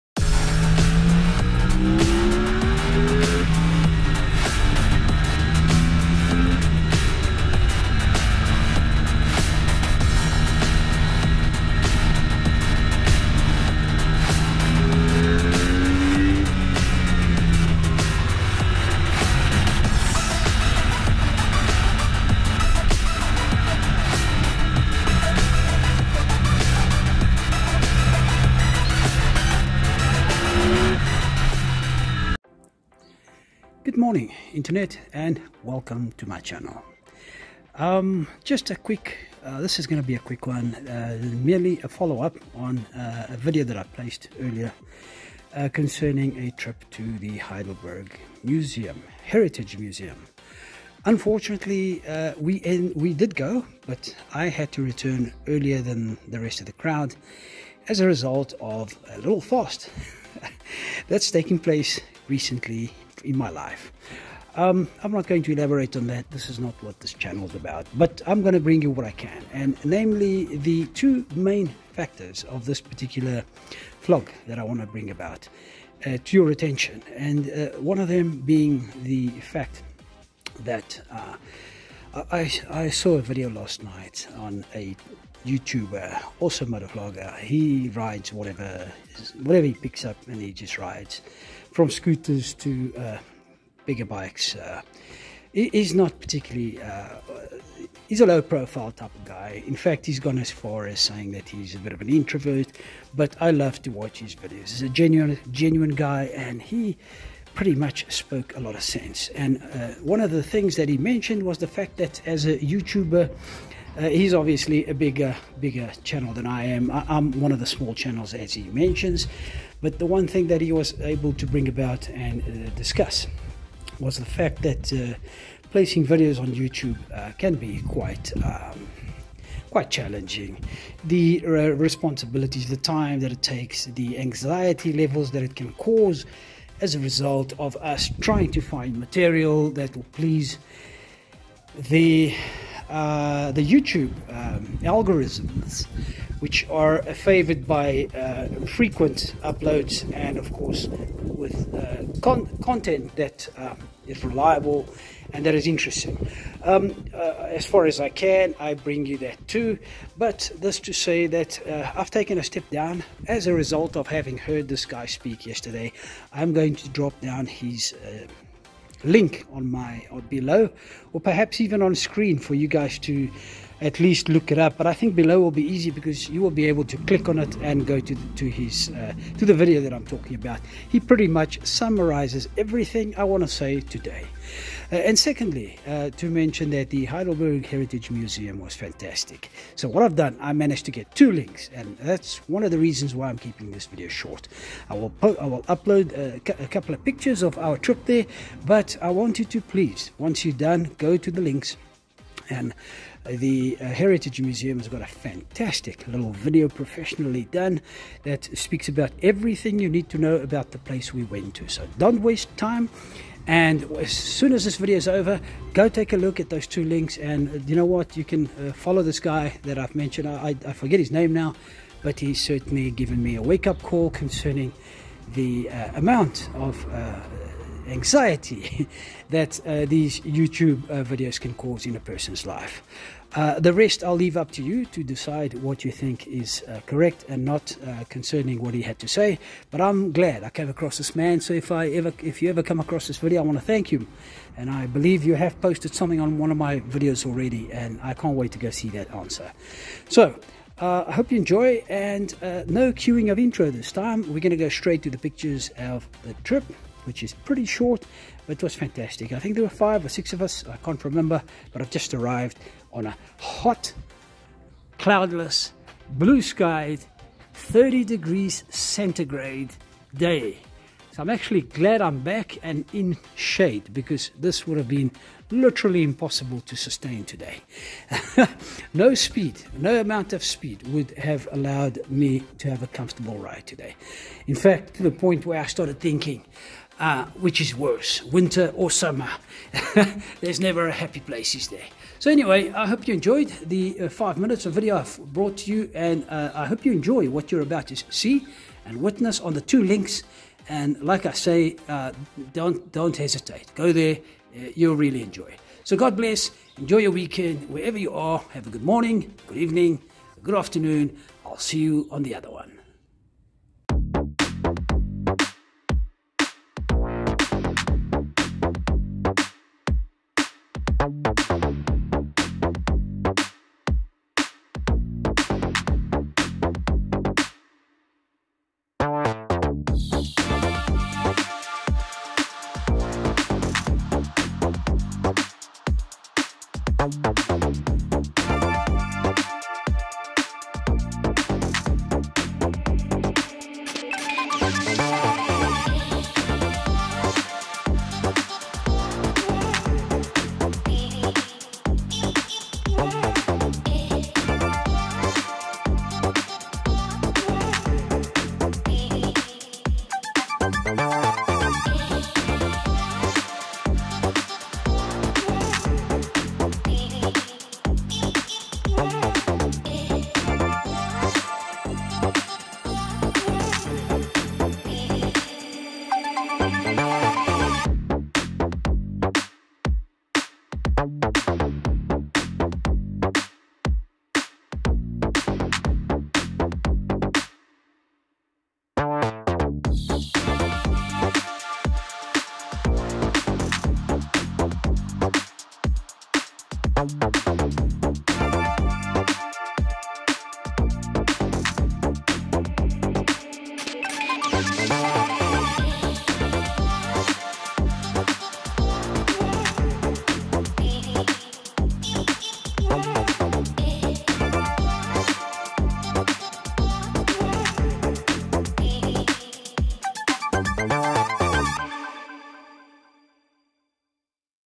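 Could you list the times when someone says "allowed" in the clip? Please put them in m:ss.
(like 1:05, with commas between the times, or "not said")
4:41.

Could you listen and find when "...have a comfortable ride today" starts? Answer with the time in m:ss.
4:42.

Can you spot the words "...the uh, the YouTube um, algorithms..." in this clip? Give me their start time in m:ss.
2:21.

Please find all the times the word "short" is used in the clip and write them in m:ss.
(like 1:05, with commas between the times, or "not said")
3:14, 4:17.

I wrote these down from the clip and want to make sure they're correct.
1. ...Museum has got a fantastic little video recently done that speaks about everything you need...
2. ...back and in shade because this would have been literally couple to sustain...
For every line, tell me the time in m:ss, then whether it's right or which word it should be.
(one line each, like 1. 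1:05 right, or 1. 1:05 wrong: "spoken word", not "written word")
1. 3:24 wrong: "professionally", not "recently"
2. 4:32 wrong: "impossible", not "couple".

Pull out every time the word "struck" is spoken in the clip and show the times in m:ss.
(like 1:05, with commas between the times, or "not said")
not said.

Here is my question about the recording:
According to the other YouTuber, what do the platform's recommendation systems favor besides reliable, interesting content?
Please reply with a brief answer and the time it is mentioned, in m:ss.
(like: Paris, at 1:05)
Frequent uploads, at 2:28.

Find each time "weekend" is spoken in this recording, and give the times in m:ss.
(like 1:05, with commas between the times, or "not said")
5:07.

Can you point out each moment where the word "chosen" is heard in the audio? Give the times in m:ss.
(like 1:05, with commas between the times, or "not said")
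not said.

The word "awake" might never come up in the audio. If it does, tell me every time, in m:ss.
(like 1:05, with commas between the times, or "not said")
not said.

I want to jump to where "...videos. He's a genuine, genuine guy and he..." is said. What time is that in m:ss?
1:44.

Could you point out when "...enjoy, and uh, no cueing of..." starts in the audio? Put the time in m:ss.
4:11.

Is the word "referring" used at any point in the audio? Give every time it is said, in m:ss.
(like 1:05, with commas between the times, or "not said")
not said.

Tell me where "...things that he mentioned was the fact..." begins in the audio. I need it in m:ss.
1:50.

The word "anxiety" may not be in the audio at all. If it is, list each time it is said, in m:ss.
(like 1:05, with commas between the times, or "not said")
2:14, 3:47.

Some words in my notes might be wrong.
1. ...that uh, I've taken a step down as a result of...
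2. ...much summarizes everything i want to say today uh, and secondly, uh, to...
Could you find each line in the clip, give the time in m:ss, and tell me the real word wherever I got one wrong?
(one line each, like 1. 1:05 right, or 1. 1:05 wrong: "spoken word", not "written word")
1. 2:41 right
2. 3:01 right.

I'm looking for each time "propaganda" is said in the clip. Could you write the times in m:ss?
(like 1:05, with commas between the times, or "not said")
not said.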